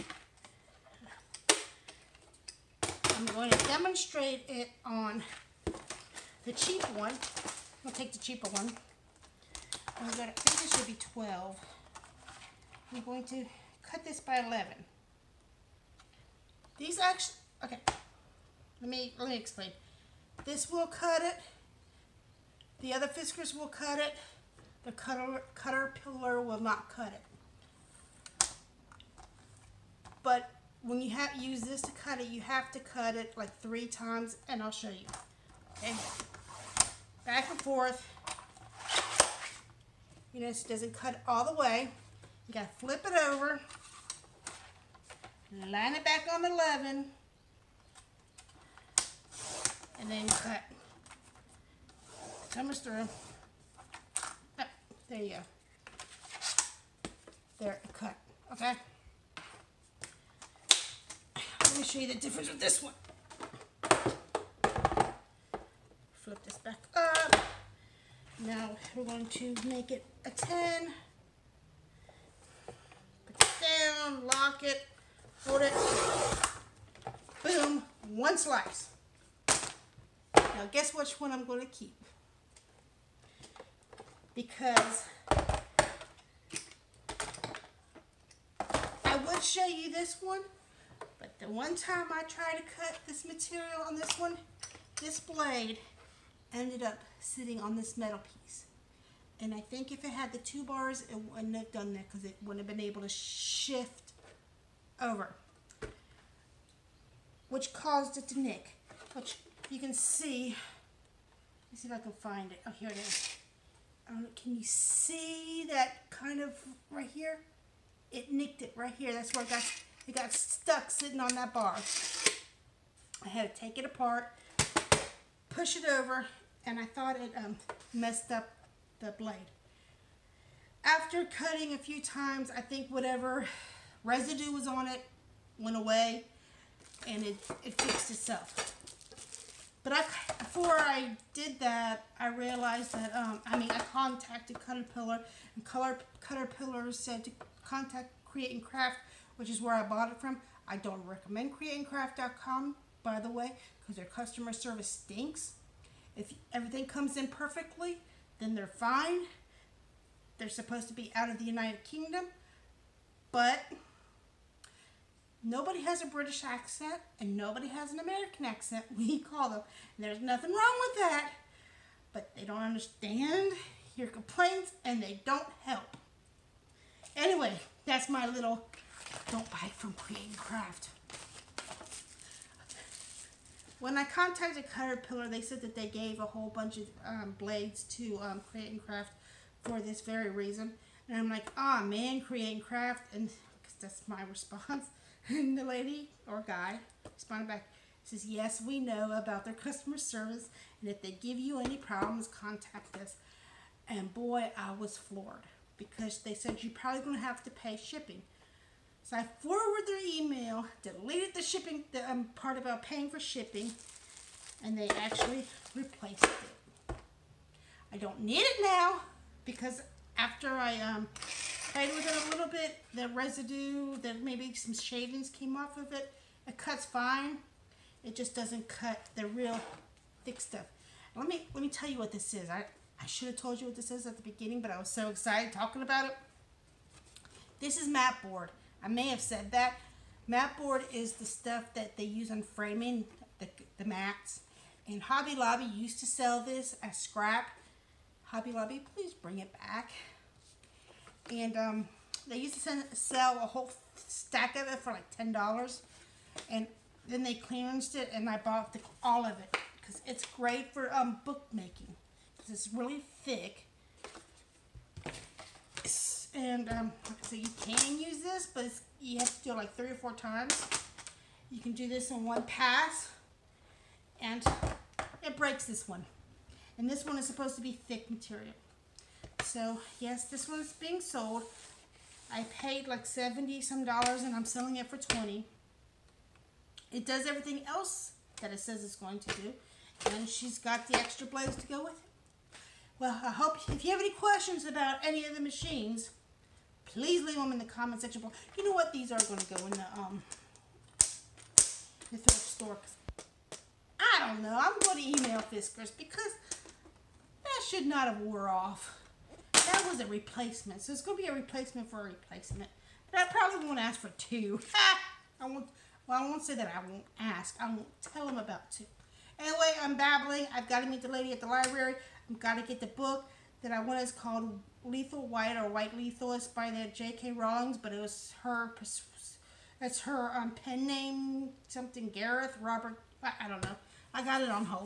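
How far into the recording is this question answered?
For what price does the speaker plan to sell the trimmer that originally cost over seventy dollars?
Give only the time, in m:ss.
4:44.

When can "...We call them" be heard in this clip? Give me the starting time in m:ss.
2:48.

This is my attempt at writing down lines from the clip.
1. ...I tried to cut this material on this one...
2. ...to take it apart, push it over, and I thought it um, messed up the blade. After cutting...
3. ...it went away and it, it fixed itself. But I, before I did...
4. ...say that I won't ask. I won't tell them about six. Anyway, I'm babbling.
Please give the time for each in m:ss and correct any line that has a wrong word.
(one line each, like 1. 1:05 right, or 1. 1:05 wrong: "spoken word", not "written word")
1. 1:32 right
2. 2:03 right
3. 2:14 right
4. 5:16 wrong: "two", not "six".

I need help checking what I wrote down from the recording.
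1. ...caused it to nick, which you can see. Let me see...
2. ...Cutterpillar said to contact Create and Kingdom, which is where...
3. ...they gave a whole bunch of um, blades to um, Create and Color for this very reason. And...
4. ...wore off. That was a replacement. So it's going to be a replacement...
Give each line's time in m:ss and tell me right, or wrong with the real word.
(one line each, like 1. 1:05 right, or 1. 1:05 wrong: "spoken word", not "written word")
1. 1:47 right
2. 2:26 wrong: "Craft", not "Kingdom"
3. 3:05 wrong: "Craft", not "Color"
4. 5:08 right.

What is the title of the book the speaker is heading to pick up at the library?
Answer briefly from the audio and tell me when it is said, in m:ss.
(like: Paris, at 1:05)
Lethal White, at 5:24.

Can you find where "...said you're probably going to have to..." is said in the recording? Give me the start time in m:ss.
3:26.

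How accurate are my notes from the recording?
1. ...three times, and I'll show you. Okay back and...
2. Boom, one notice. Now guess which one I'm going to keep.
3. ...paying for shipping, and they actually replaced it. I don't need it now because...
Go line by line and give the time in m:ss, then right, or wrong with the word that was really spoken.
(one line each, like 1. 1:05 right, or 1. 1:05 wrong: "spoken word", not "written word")
1. 0:33 right
2. 1:17 wrong: "slice", not "notice"
3. 3:32 right.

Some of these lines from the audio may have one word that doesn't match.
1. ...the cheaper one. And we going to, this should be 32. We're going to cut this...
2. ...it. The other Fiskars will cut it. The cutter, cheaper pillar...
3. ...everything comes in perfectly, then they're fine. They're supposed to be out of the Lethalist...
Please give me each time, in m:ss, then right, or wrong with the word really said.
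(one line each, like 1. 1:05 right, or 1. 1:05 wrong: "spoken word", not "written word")
1. 0:08 wrong: "12", not "32"
2. 0:21 wrong: "cutter", not "cheaper"
3. 2:36 wrong: "United", not "Lethalist".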